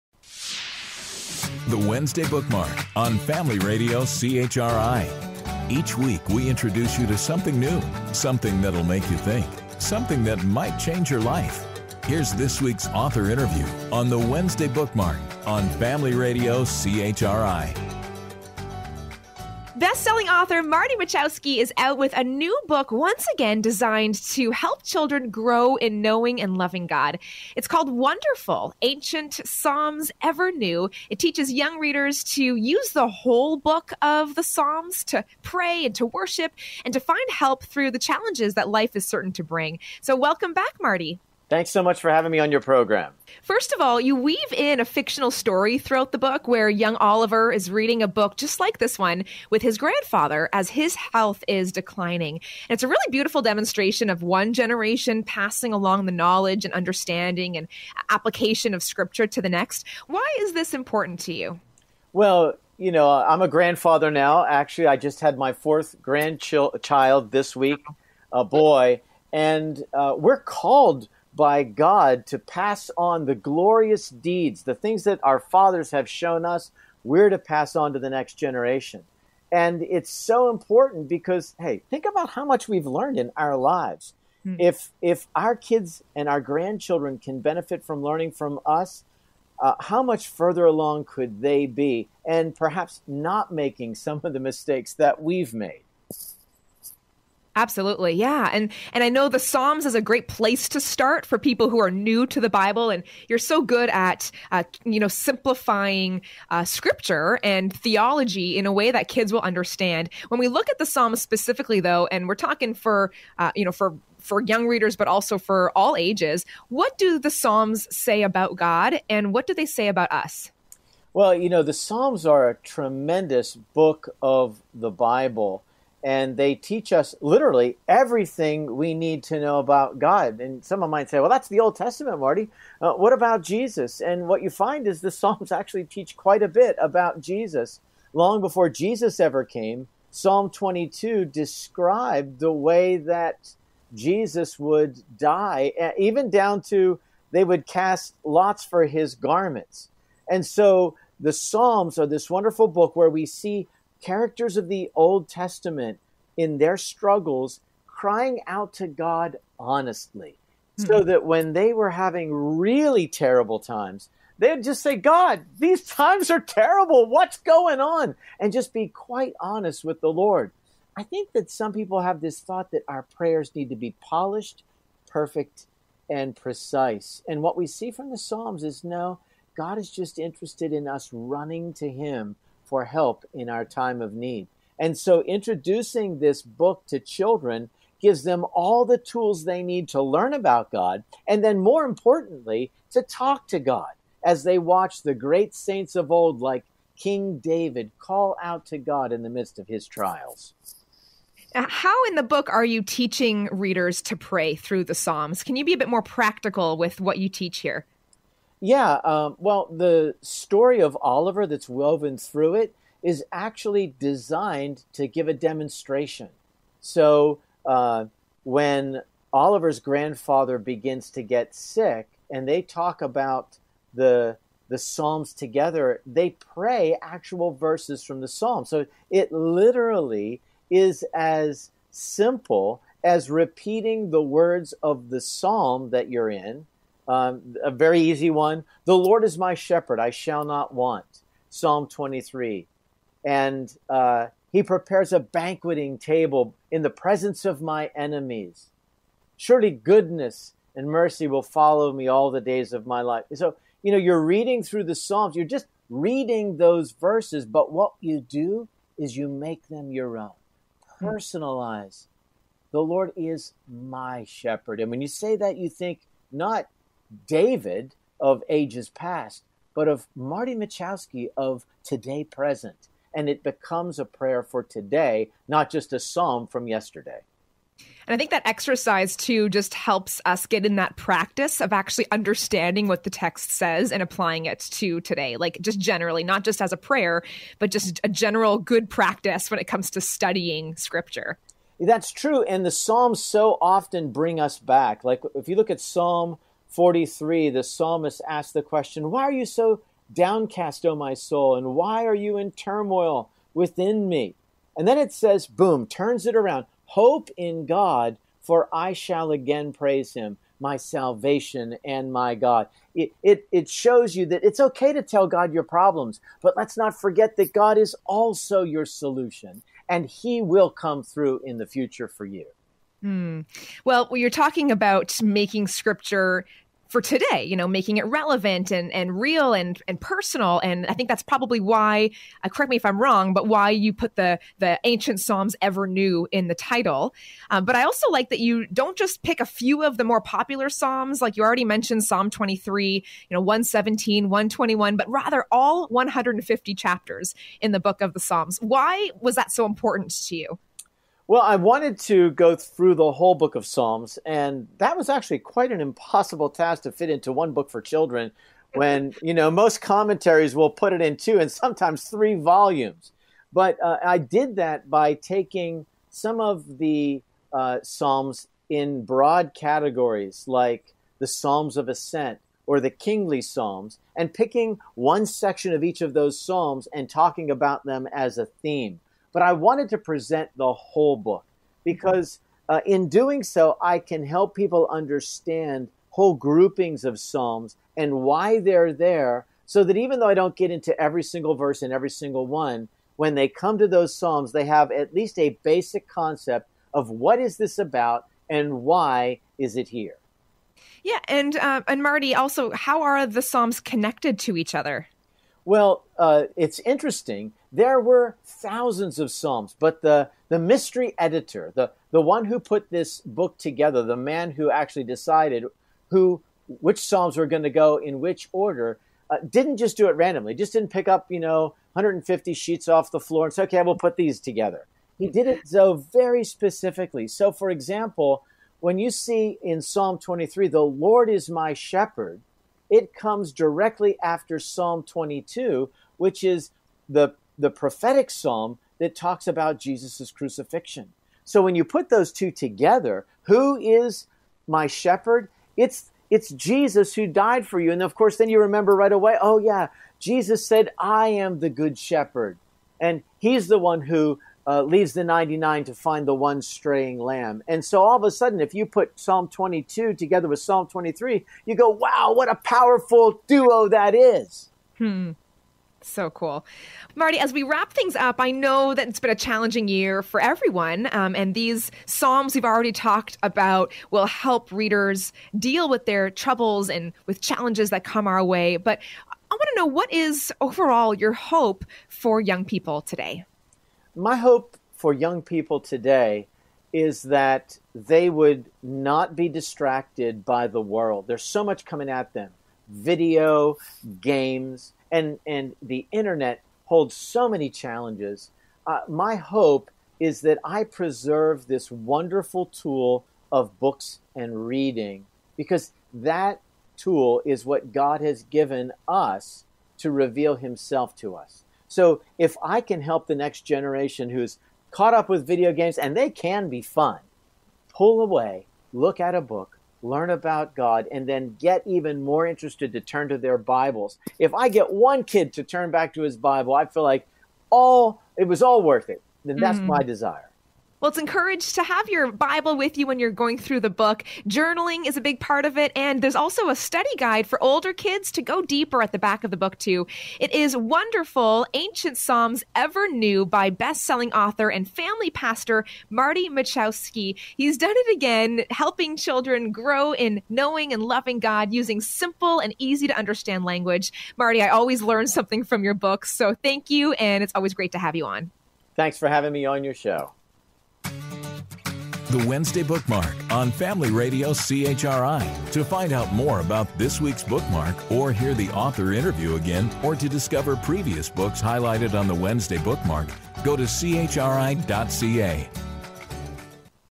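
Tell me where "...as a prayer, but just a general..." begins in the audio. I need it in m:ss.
4:46.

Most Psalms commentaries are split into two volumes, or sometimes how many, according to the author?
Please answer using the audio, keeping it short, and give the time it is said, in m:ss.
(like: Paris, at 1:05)
3, at 6:02.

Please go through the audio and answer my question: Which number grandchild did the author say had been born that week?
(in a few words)
fourth.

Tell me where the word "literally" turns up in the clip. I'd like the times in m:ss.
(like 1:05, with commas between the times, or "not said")
2:07, 3:49.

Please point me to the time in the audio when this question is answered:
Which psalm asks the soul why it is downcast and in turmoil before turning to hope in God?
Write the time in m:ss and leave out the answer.
4:55.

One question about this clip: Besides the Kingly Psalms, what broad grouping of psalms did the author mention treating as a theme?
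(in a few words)
Psalms of Ascent.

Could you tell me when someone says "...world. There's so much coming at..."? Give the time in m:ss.
8:10.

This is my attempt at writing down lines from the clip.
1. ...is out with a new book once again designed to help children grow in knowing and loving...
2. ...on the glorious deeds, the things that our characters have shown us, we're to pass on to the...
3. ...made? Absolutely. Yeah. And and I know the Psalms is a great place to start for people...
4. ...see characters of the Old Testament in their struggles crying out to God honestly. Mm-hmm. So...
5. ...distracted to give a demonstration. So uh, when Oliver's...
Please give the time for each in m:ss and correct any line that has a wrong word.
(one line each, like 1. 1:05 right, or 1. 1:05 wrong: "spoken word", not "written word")
1. 0:21 right
2. 1:12 wrong: "fathers", not "characters"
3. 1:35 right
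4. 2:33 right
5. 3:33 wrong: "designed", not "distracted".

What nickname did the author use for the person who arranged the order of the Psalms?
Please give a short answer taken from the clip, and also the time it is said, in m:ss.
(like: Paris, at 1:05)
mystery editor, at 6:50.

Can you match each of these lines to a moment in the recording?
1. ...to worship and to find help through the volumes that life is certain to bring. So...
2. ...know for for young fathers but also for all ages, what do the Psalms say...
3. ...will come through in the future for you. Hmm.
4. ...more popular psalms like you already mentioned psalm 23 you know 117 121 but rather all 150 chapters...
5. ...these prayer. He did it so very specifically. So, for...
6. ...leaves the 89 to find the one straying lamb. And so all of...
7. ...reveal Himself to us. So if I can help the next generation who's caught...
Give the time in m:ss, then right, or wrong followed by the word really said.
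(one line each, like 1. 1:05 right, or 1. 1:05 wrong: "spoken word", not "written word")
1. 0:35 wrong: "challenges", not "volumes"
2. 1:53 wrong: "readers", not "fathers"
3. 5:20 right
4. 5:40 right
5. 7:04 wrong: "together", not "prayer"
6. 7:34 wrong: "99", not "89"
7. 8:30 right.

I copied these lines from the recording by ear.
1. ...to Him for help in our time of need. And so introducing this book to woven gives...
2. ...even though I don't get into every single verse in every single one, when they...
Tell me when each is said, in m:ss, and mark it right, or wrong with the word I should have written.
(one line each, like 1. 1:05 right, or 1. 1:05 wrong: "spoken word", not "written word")
1. 3:01 wrong: "children", not "woven"
2. 6:29 right.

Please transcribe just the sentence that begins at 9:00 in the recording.
It is Wonderful Ancient Psalms Ever New by best selling author and family pastor Marty Machowski.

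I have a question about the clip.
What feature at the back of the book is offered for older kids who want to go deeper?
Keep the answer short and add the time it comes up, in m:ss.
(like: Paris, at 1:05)
study guide, at 8:56.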